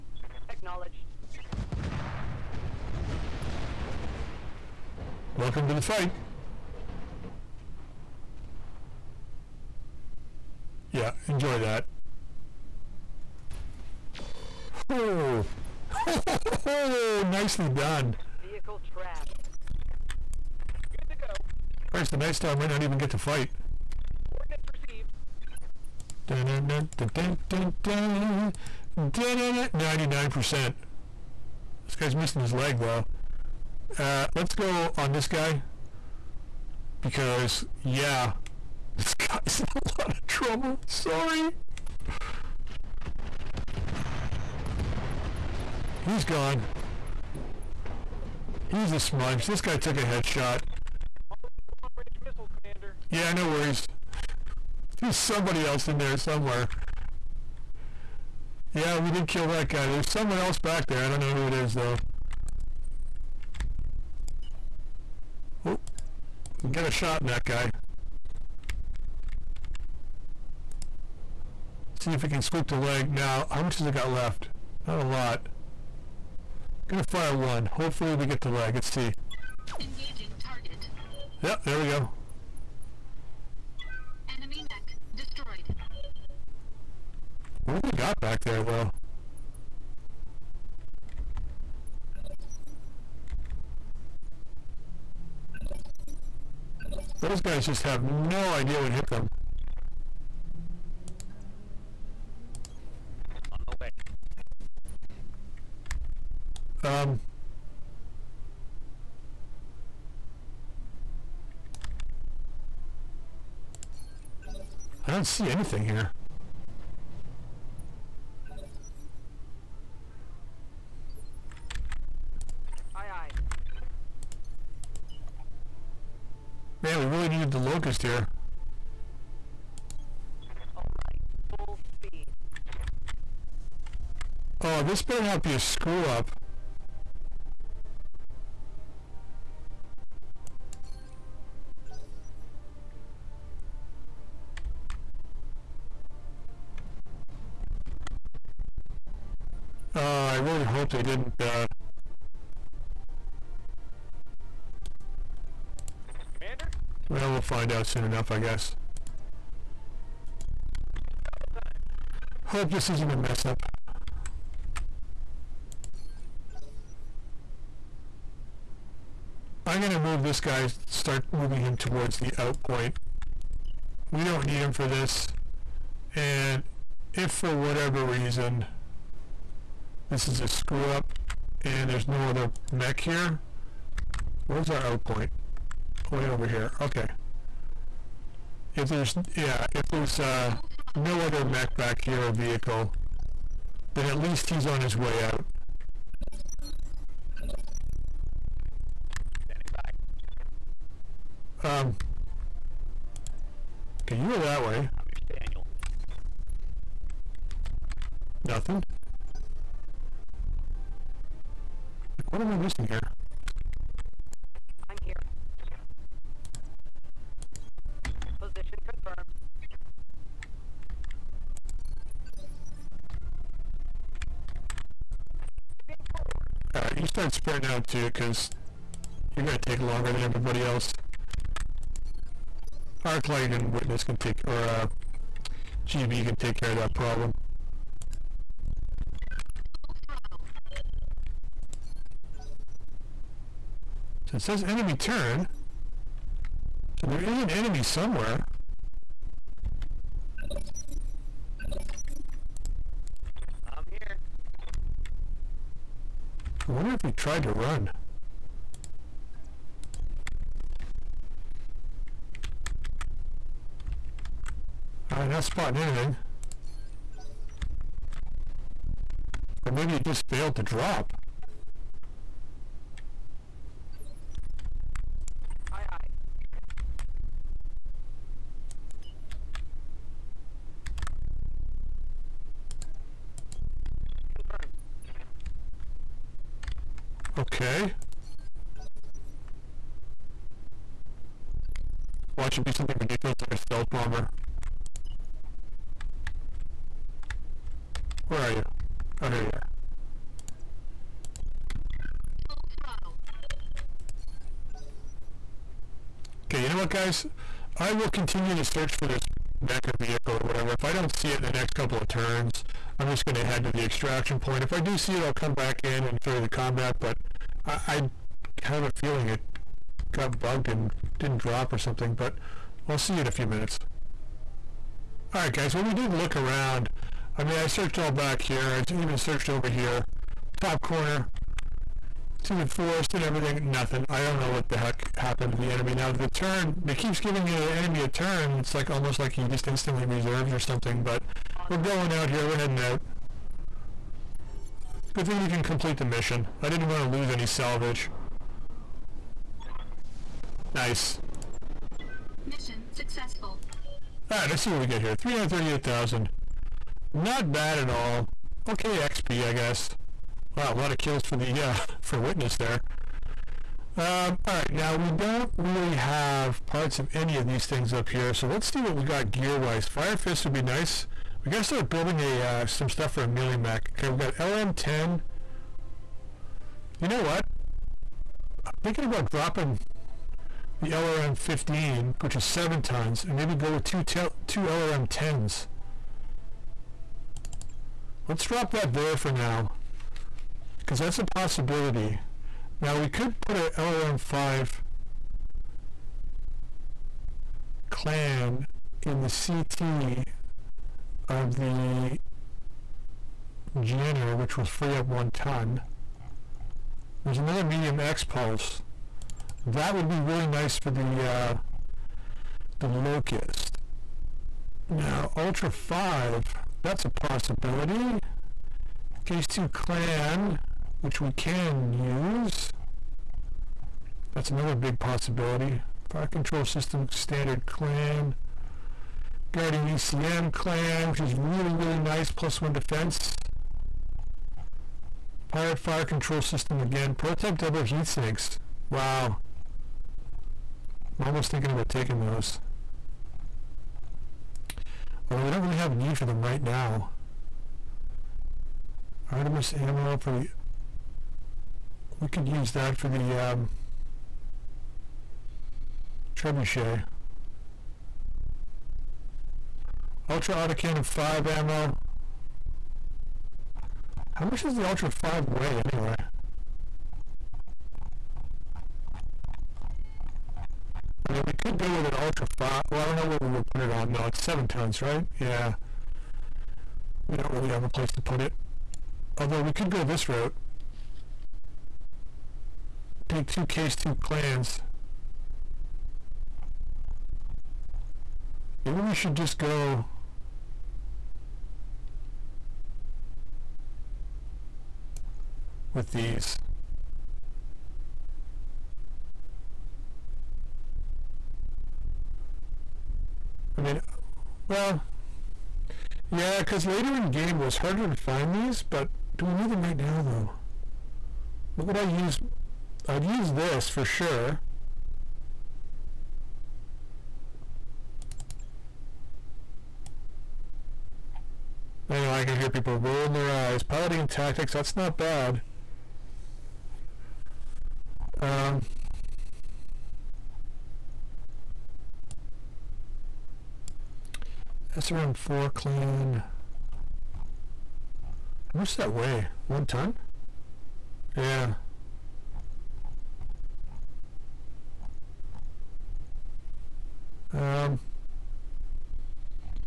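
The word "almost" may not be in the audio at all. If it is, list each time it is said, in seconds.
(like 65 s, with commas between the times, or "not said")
338 s, 441 s.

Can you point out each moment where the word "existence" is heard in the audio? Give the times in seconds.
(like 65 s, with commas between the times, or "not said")
not said.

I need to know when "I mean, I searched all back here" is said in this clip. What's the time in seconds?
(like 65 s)
327 s.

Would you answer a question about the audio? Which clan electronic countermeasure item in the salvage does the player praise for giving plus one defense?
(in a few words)
Guardian ECM.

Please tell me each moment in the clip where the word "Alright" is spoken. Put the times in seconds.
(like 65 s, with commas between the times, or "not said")
226 s, 354 s, 364 s.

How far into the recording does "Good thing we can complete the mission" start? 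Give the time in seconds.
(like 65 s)
345 s.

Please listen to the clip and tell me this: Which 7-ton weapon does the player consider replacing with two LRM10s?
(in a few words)
LRM15.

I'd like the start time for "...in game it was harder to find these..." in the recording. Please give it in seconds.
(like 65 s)
507 s.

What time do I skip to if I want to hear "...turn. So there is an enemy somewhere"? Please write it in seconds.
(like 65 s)
244 s.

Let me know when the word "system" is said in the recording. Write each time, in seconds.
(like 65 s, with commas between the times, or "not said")
426 s, 436 s.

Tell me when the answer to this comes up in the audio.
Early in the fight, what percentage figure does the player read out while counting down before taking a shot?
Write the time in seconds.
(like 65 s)
29 s.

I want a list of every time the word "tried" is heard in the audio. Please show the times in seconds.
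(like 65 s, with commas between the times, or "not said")
257 s.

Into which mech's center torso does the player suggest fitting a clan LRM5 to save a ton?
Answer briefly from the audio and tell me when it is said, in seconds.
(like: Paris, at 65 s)
Jenner, at 403 s.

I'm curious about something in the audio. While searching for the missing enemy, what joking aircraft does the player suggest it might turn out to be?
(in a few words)
Stealth bomber.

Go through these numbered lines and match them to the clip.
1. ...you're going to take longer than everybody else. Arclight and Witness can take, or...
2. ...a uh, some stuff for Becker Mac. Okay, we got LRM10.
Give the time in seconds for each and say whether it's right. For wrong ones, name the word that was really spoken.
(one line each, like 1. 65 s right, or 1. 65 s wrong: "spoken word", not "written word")
1. 229 s right
2. 372 s wrong: "Amelia", not "Becker".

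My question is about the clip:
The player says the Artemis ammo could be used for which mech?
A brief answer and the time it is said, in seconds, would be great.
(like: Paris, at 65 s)
Trebuchet, at 456 s.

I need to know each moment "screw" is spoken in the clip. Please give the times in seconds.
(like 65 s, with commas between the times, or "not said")
135 s, 180 s.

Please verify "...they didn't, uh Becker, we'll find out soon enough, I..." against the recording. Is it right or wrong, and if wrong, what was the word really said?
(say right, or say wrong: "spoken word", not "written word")
wrong: "Well", not "Becker".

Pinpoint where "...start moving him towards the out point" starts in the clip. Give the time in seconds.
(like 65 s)
170 s.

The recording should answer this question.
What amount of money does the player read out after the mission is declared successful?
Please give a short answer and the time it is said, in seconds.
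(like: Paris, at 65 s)
338,000, at 355 s.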